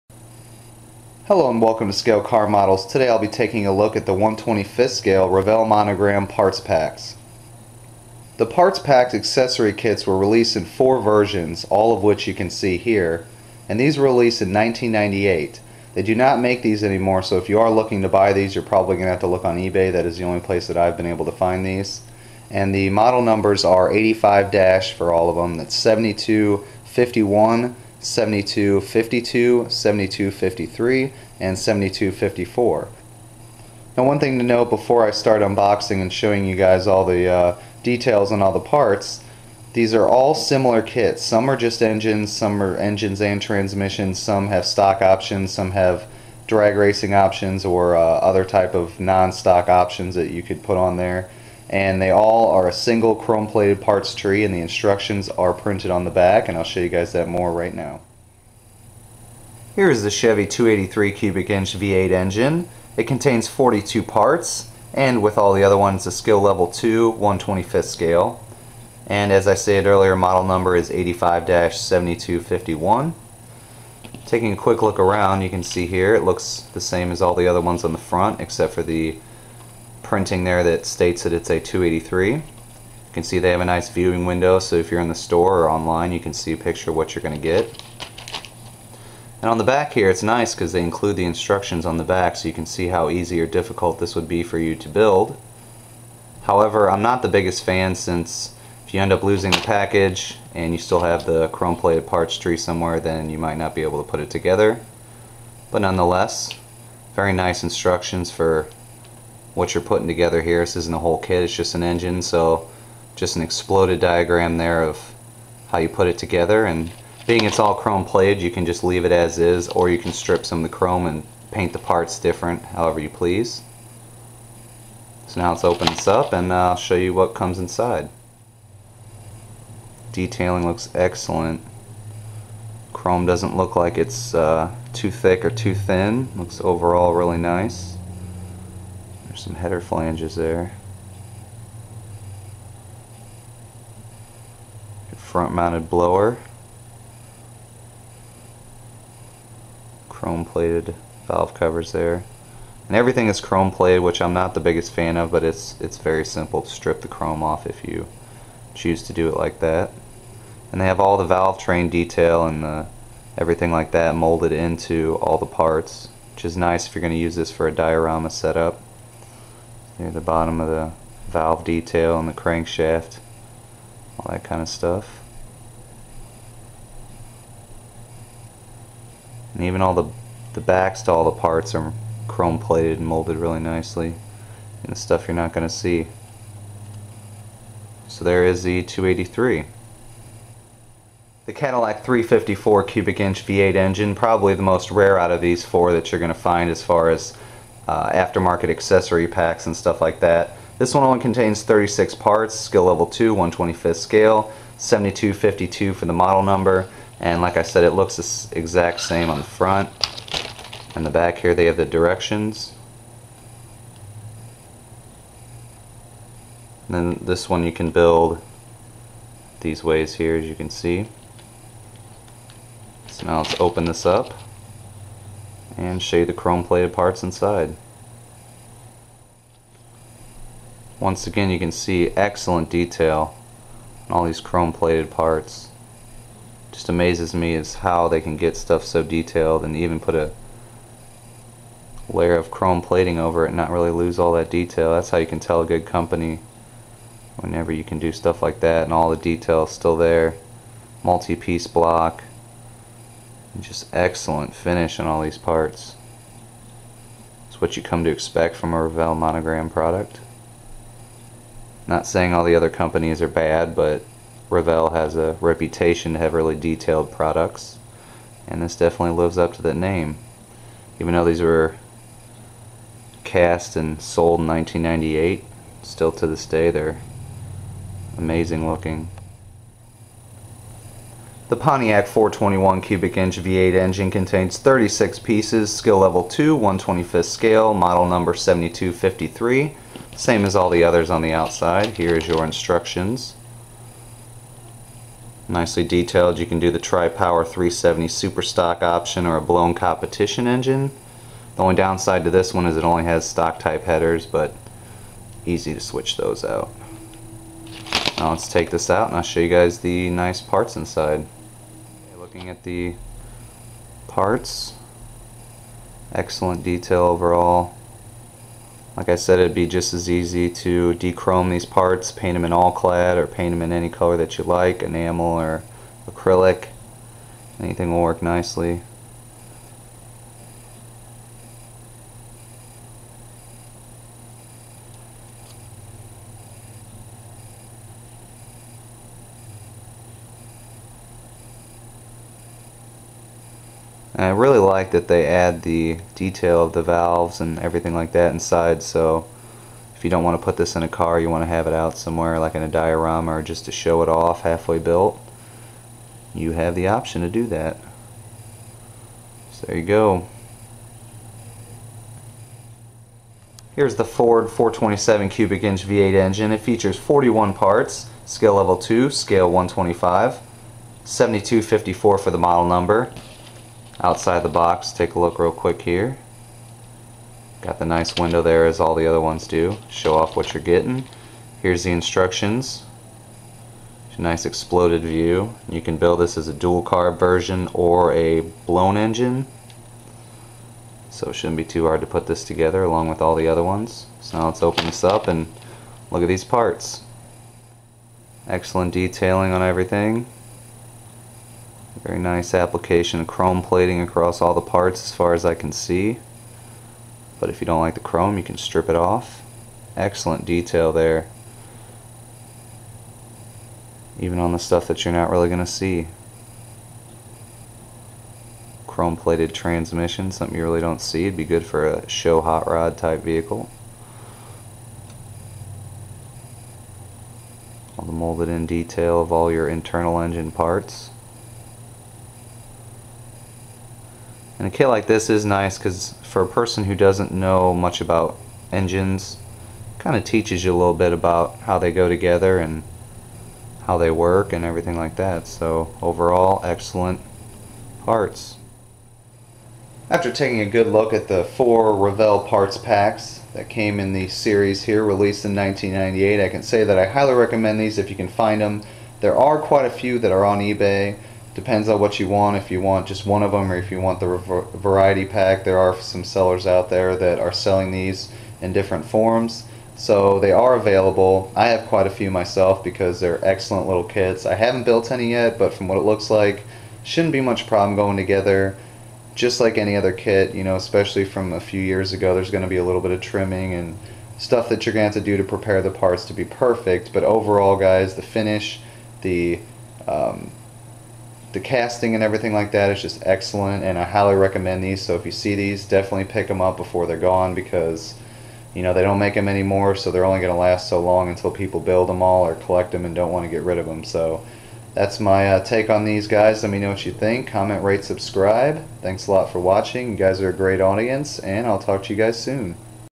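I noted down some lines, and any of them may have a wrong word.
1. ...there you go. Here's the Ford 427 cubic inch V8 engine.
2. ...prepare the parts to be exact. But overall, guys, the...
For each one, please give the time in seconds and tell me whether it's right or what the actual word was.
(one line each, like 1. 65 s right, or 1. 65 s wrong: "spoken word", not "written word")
1. 359 s right
2. 485 s wrong: "perfect", not "exact".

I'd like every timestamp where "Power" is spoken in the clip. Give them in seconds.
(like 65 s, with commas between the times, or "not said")
296 s.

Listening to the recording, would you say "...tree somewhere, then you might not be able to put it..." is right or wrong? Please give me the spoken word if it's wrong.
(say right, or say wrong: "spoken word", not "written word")
right.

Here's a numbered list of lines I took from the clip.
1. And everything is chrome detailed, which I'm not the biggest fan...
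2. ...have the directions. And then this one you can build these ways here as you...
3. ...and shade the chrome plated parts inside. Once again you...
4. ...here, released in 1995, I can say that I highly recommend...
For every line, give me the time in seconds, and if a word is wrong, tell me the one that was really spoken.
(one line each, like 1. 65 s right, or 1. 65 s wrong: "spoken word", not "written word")
1. 152 s wrong: "plated", not "detailed"
2. 211 s right
3. 225 s right
4. 454 s wrong: "1998", not "1995".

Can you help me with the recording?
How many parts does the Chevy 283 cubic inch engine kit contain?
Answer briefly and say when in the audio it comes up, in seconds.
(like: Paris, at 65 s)
42, at 62 s.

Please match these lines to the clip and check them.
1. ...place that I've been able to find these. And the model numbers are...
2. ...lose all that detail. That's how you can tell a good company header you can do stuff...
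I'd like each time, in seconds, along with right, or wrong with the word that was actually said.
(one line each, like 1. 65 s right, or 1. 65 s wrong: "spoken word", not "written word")
1. 20 s right
2. 243 s wrong: "whenever", not "header".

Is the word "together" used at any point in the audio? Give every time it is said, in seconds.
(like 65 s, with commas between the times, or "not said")
104 s, 110 s, 116 s, 392 s, 442 s, 478 s.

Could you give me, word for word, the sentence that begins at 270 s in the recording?
Even though these were cast and sold in 1998, still to this day they're amazing looking.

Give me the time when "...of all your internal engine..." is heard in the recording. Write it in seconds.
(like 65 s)
429 s.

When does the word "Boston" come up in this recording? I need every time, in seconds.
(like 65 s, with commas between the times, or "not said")
not said.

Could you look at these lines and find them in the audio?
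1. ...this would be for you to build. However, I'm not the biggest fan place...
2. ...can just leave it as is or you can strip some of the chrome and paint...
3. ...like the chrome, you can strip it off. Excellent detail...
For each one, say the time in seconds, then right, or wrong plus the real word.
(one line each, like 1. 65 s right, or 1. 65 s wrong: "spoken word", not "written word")
1. 94 s wrong: "since", not "place"
2. 118 s right
3. 407 s right.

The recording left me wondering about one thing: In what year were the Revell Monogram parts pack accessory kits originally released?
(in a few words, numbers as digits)
1998.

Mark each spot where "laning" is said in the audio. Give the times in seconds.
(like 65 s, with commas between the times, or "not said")
not said.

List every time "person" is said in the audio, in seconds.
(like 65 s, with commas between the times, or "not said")
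436 s.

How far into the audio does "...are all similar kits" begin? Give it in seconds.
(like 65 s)
39 s.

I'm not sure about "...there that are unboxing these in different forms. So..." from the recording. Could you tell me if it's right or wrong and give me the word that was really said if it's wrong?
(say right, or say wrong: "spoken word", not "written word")
wrong: "selling", not "unboxing".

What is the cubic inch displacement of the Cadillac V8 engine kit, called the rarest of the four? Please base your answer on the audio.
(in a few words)
354.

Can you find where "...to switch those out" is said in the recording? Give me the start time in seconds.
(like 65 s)
305 s.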